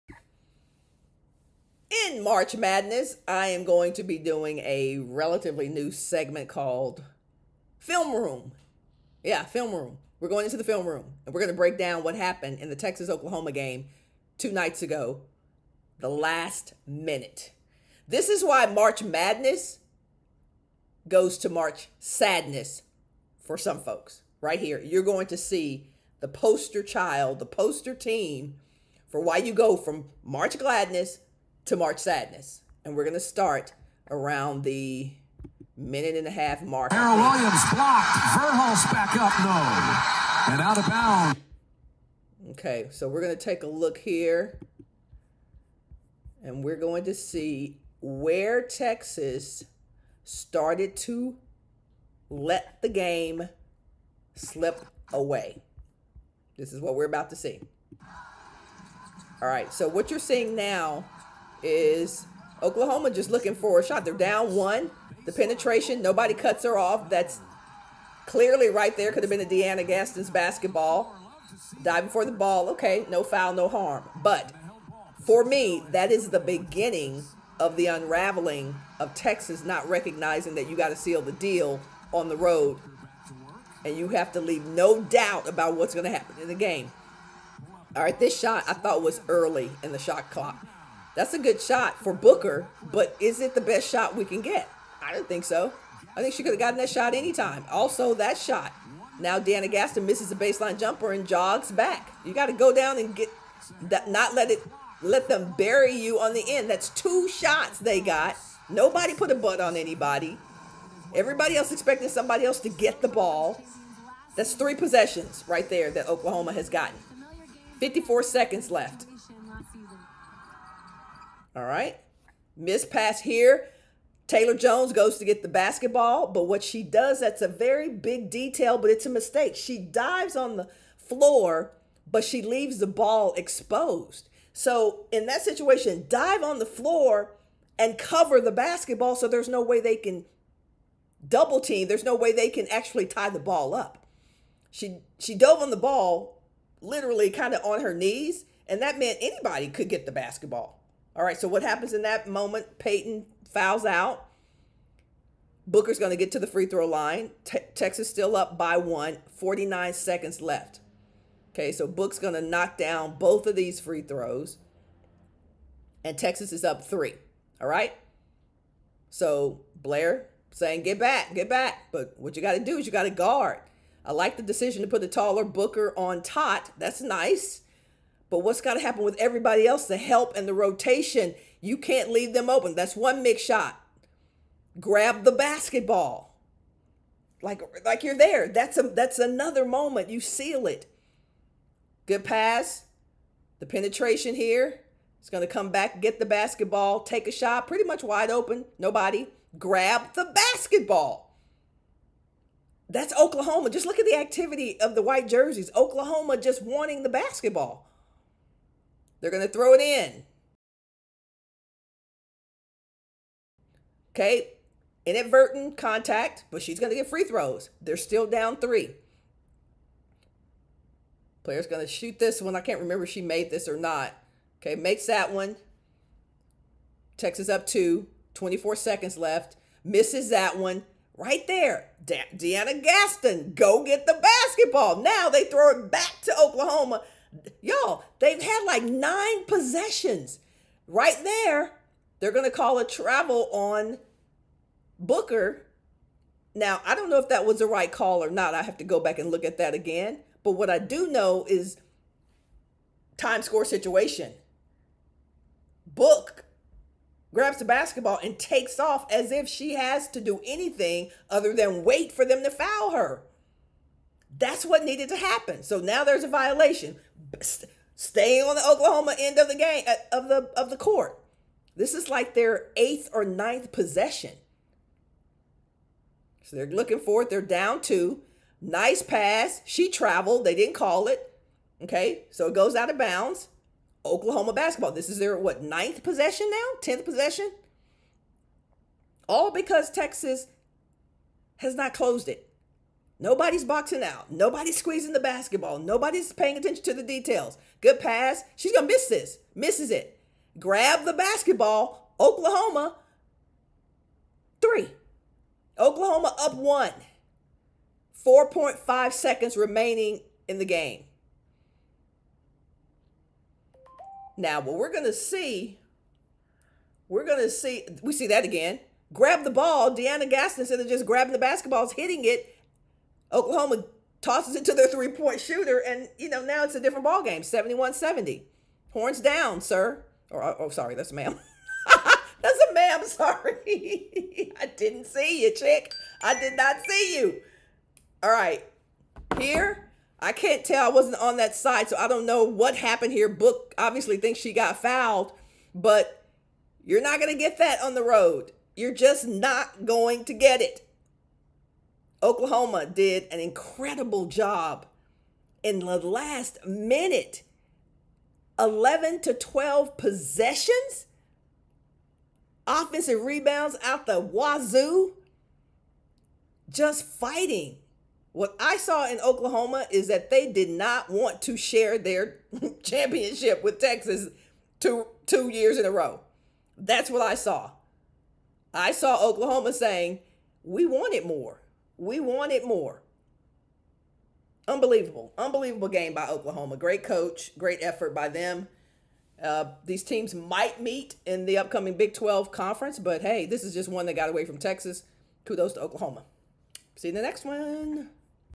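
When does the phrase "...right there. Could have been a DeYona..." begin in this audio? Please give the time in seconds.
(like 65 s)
68 s.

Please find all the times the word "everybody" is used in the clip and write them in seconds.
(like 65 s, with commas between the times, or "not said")
111 s, 179 s.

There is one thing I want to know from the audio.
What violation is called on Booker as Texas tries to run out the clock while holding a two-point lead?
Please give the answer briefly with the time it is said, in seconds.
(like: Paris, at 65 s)
travel, at 242 s.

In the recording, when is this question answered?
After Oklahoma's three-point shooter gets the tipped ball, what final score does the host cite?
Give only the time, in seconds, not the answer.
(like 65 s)
327 s.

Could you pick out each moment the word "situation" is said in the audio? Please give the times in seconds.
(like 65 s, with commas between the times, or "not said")
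135 s, 253 s.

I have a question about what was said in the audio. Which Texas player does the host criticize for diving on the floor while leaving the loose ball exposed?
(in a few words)
Taylor Jones.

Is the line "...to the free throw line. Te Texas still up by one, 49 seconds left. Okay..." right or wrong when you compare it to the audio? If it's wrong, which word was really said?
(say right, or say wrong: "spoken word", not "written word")
right.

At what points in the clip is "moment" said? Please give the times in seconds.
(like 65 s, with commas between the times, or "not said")
152 s, 189 s.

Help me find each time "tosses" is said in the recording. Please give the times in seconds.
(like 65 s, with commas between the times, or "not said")
324 s.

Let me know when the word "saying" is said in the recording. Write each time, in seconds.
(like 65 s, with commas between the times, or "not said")
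170 s, 379 s.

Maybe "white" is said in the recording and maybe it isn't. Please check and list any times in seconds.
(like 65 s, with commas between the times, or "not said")
205 s.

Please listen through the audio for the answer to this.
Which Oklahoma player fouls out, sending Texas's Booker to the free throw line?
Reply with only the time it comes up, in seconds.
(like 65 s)
152 s.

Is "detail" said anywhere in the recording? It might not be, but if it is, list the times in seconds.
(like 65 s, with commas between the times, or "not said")
128 s, 297 s.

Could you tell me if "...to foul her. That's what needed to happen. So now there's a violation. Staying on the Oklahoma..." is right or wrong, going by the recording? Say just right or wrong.
right.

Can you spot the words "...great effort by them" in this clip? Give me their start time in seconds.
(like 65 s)
387 s.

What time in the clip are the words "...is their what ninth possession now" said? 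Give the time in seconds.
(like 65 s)
285 s.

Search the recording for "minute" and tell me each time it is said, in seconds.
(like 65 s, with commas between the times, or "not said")
16 s, 35 s, 356 s.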